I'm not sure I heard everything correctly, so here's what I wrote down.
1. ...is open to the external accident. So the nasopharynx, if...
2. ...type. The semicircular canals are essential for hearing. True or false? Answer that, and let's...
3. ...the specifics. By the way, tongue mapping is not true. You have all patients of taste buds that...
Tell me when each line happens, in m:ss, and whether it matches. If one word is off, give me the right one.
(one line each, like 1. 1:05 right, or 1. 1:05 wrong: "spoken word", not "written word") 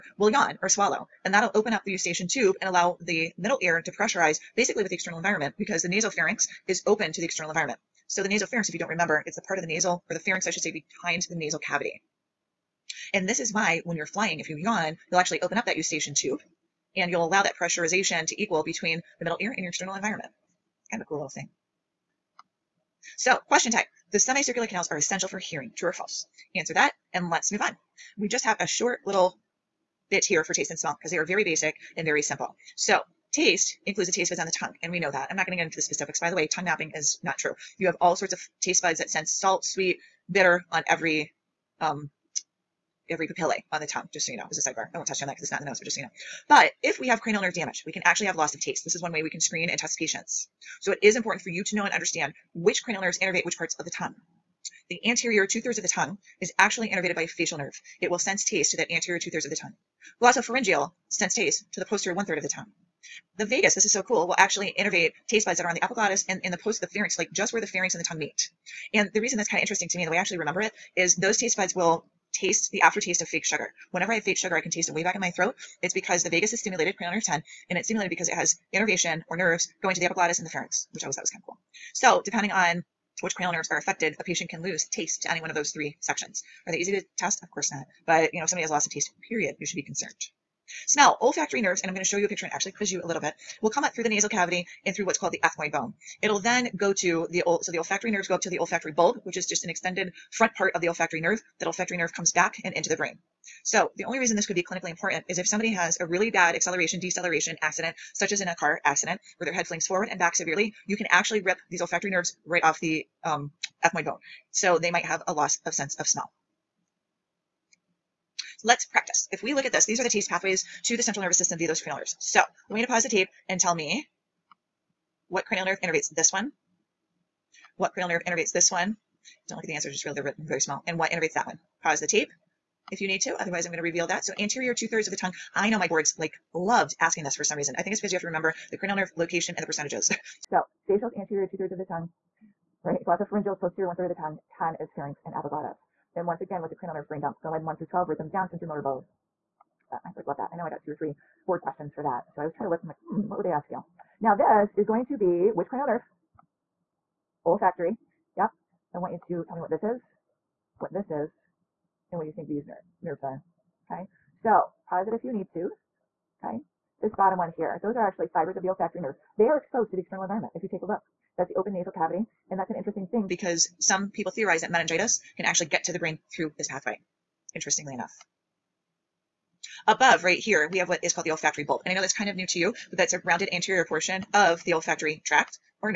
1. 0:06 wrong: "environment", not "accident"
2. 0:23 right
3. 0:35 wrong: "sorts", not "patients".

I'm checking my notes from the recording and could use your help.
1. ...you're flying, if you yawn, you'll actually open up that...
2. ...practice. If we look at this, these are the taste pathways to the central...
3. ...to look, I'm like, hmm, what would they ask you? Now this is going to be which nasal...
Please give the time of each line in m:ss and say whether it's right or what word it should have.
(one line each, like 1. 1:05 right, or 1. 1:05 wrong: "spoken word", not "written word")
1. 0:13 right
2. 1:58 right
3. 2:32 wrong: "cranial", not "nasal".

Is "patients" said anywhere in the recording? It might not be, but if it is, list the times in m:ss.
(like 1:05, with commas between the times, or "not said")
0:49, 1:24.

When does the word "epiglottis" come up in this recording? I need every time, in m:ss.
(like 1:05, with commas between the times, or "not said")
1:05, 1:20, 2:25.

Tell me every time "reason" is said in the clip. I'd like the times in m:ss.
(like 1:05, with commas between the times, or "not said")
1:09, 1:44, 2:17.